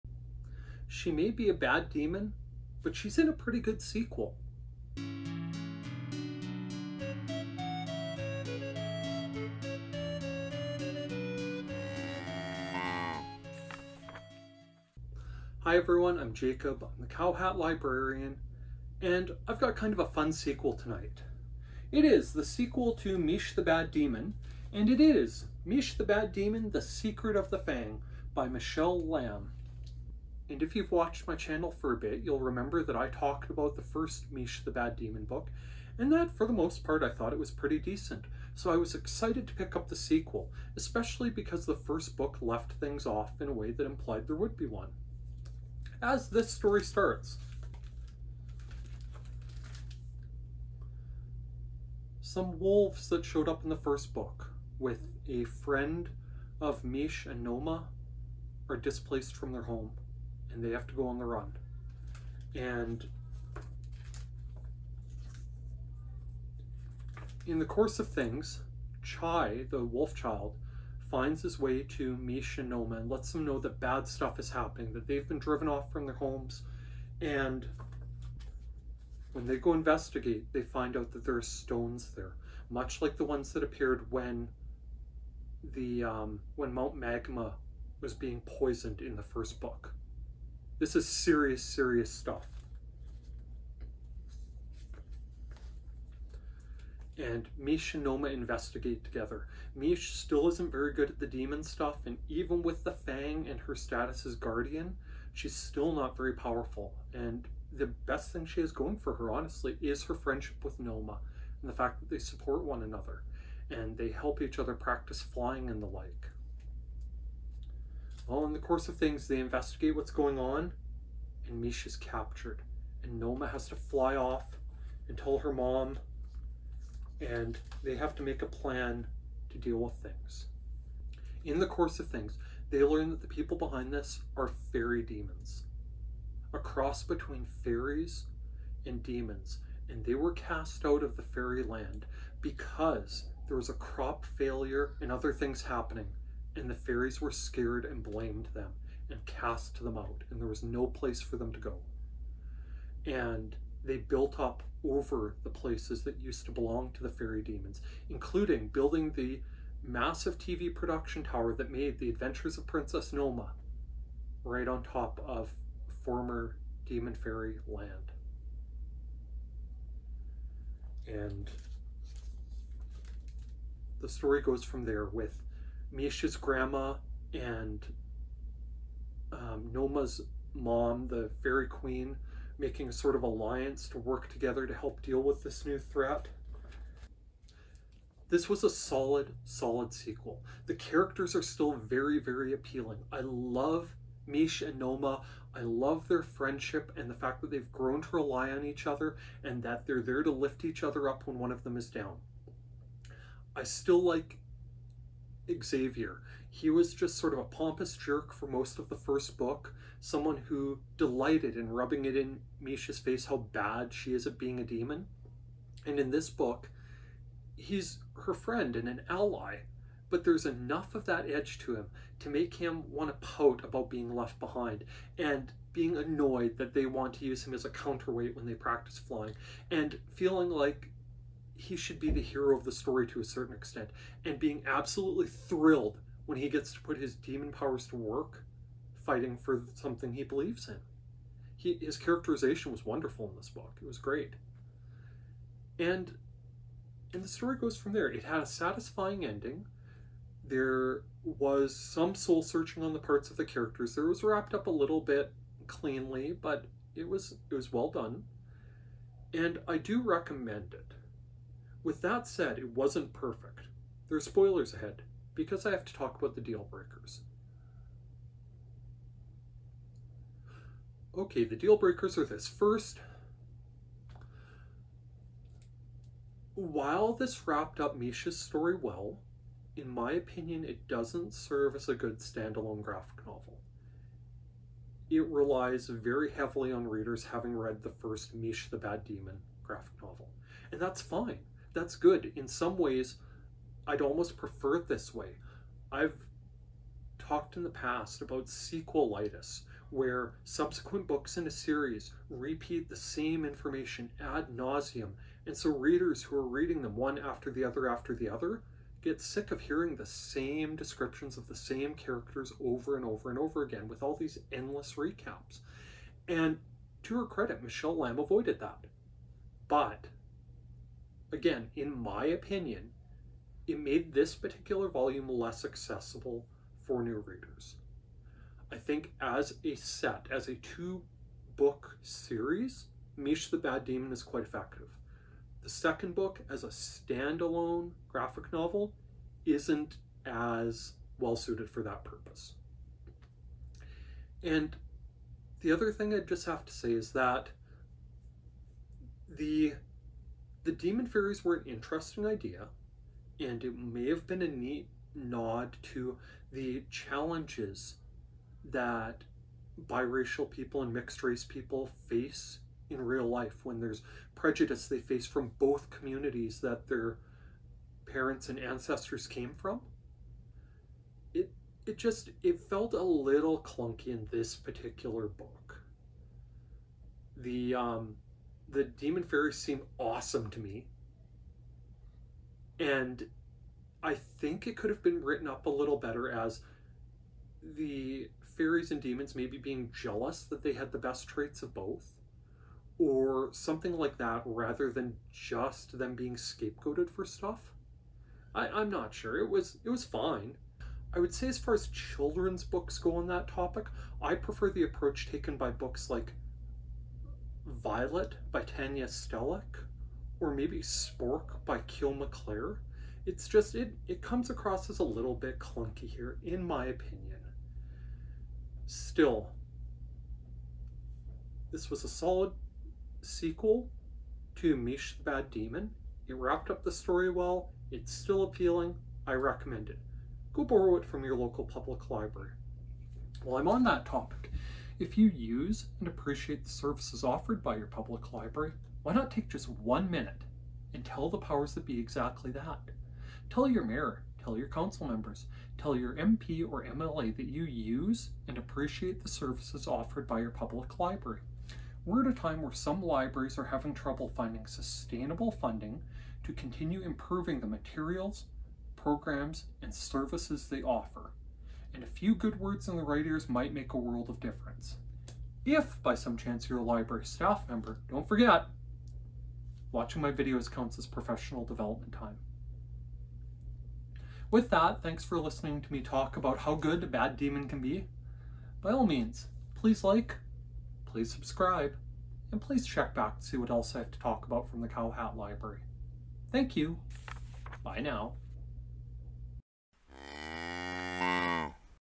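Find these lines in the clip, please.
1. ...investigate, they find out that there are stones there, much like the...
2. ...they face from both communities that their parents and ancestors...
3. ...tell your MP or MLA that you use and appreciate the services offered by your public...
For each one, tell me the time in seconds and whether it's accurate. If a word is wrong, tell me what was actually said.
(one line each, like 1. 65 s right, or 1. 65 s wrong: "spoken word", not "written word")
1. 79 s right
2. 364 s right
3. 445 s right.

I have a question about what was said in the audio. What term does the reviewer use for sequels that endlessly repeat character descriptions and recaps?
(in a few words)
sequelitis.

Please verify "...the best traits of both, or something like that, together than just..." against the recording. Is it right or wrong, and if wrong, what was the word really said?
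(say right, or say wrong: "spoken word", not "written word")
wrong: "rather", not "together".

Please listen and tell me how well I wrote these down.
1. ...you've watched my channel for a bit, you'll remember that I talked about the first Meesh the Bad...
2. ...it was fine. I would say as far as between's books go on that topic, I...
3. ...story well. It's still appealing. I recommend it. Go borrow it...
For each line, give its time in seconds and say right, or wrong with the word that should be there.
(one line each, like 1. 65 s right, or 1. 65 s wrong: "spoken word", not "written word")
1. 30 s right
2. 399 s wrong: "children", not "between"
3. 426 s right.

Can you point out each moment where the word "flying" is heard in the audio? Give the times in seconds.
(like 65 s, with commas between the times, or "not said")
115 s, 228 s.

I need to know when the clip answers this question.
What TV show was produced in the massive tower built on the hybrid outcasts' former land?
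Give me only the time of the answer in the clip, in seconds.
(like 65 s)
161 s.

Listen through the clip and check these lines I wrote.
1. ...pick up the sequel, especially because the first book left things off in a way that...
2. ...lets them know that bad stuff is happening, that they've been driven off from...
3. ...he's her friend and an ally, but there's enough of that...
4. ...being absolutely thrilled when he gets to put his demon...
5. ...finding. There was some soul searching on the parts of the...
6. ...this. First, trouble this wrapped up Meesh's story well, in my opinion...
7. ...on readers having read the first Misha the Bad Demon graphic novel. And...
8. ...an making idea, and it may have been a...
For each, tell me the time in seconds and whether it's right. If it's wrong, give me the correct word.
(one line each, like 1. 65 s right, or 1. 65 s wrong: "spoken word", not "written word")
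1. 39 s right
2. 73 s right
3. 217 s right
4. 234 s right
5. 249 s wrong: "ending", not "finding"
6. 272 s wrong: "while", not "trouble"
7. 286 s right
8. 351 s wrong: "interesting", not "making".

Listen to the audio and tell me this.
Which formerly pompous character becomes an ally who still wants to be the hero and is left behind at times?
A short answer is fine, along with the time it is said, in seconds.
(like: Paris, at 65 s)
Xavier, at 205 s.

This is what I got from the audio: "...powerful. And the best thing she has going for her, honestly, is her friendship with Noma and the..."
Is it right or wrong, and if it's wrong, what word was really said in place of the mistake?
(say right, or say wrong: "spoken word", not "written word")
right.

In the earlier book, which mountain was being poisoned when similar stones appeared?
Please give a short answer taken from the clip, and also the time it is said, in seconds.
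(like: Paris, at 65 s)
Mount Magma, at 86 s.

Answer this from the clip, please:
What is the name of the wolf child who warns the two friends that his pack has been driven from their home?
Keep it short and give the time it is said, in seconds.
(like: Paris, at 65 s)
Chai, at 69 s.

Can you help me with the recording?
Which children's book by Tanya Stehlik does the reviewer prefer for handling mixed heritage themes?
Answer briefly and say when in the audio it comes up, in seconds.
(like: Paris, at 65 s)
Violet, at 407 s.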